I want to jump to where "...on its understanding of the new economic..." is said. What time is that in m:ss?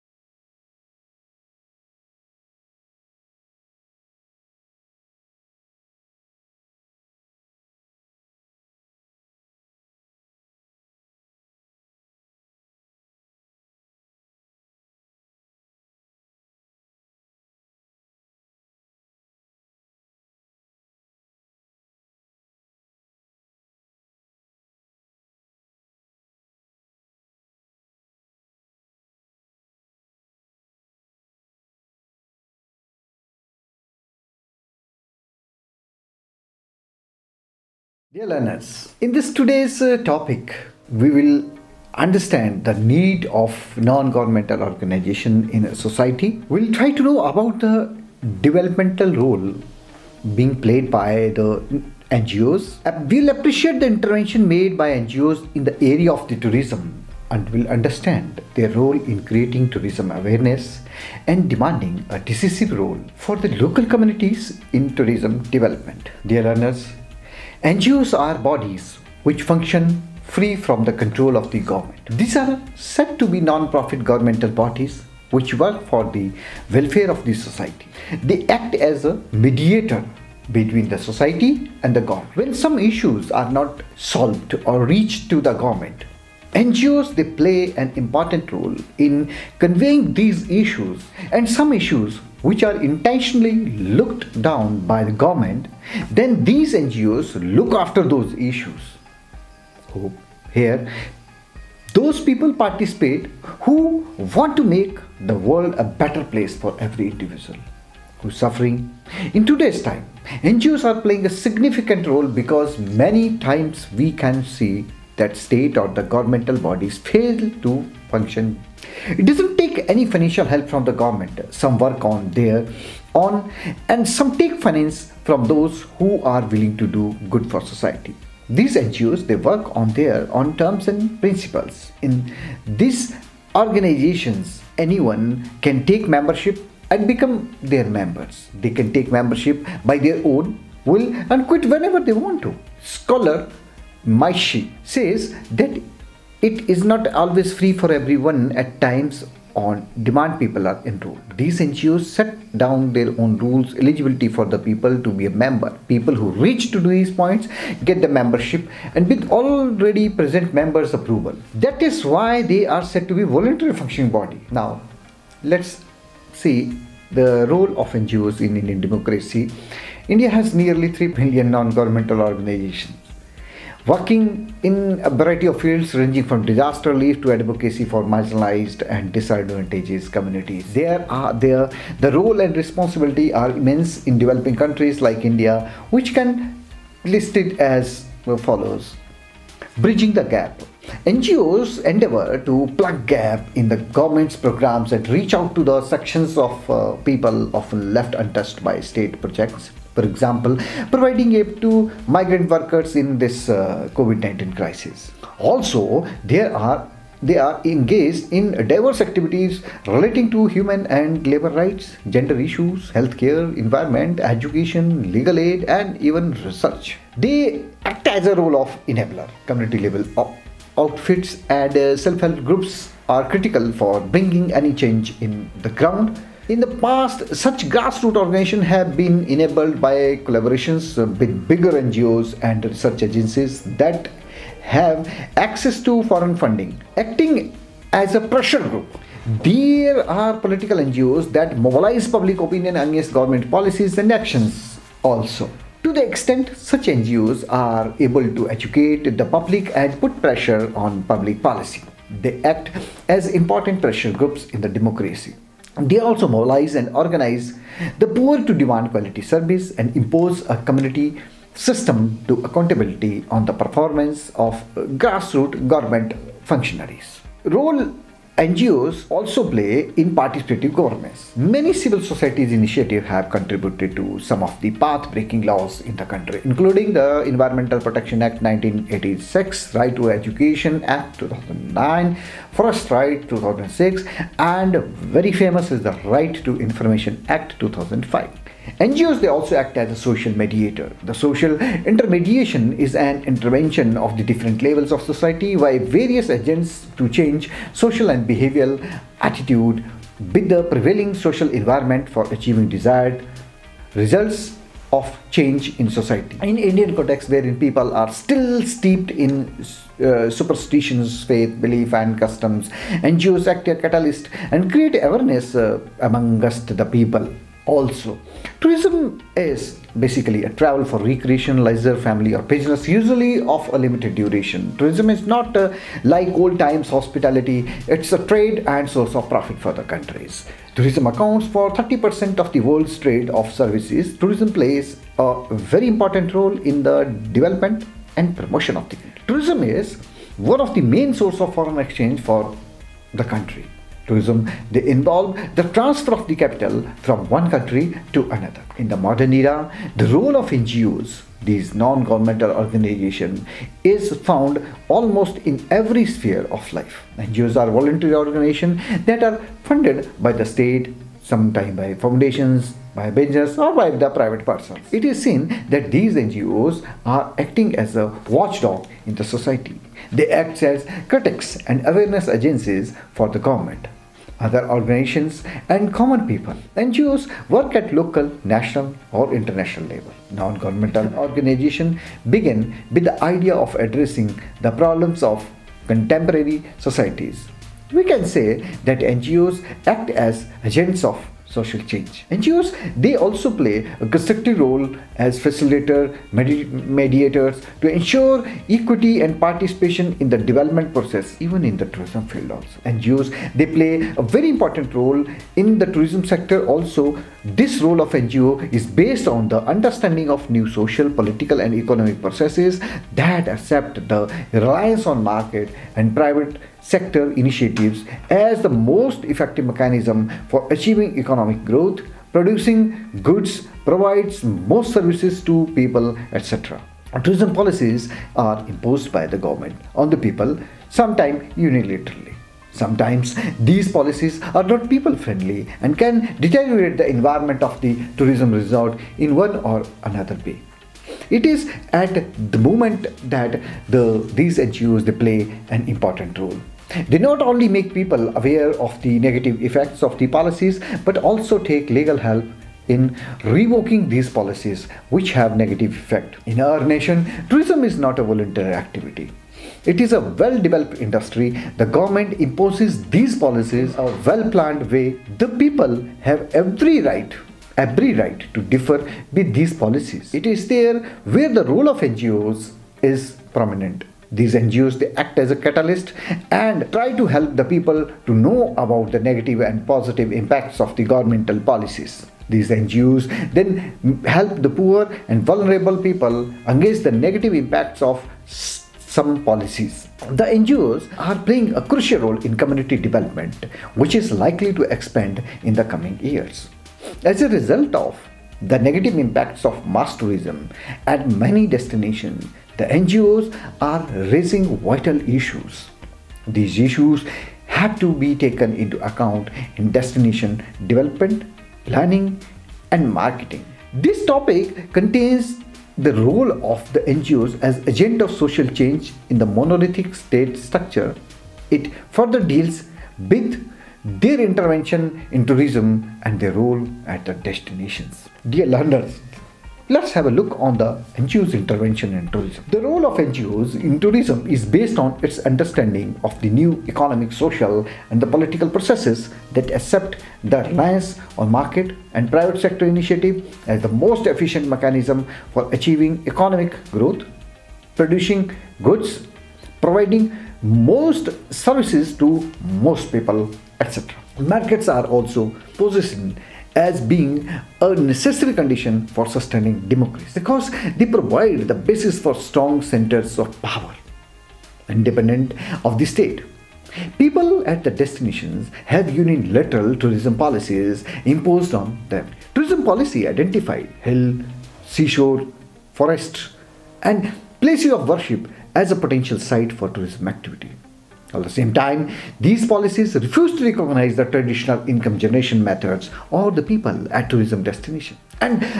8:54.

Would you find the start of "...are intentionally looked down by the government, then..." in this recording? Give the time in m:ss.
1:32.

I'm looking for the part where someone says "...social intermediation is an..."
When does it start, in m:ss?
4:51.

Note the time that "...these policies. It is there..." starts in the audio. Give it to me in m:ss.
7:49.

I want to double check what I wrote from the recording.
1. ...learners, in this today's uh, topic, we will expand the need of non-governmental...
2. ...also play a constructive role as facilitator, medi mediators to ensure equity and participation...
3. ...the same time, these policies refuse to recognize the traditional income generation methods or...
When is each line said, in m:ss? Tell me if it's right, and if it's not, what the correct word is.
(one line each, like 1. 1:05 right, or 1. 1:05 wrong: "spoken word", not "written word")
1. 0:38 wrong: "understand", not "expand"
2. 6:33 right
3. 9:41 right.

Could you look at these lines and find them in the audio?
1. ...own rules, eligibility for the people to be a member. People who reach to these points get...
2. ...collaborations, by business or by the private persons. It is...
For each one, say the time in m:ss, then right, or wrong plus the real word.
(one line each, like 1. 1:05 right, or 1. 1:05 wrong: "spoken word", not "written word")
1. 2:33 right
2. 6:01 wrong: "foundations", not "collaborations".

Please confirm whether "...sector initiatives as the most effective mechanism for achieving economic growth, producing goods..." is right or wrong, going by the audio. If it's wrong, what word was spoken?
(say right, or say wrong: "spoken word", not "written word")
right.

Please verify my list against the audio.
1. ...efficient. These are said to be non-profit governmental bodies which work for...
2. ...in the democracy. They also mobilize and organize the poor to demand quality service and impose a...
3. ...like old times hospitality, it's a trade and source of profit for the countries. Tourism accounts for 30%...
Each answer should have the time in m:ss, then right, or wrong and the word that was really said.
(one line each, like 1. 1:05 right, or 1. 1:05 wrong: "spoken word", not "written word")
1. 1:11 wrong: "government", not "efficient"
2. 4:14 right
3. 5:26 right.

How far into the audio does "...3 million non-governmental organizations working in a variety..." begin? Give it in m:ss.
2:50.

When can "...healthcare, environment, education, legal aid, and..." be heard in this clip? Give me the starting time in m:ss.
3:32.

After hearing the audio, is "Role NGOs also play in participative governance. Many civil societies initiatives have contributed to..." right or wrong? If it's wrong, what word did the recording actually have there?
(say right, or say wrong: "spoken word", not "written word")
right.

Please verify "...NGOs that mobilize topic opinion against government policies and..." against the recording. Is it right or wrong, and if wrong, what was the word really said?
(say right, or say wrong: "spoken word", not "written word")
wrong: "public", not "topic".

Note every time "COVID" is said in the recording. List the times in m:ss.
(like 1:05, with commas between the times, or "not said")
3:23.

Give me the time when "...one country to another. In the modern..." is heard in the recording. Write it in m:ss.
5:47.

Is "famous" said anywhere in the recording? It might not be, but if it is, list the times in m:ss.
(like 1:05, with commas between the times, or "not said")
4:45.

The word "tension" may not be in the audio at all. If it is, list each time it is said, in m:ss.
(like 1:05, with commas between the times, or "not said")
not said.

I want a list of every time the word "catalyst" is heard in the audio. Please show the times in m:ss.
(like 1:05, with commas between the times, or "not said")
5:13, 7:55.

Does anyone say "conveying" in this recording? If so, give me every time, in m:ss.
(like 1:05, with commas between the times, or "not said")
1:29.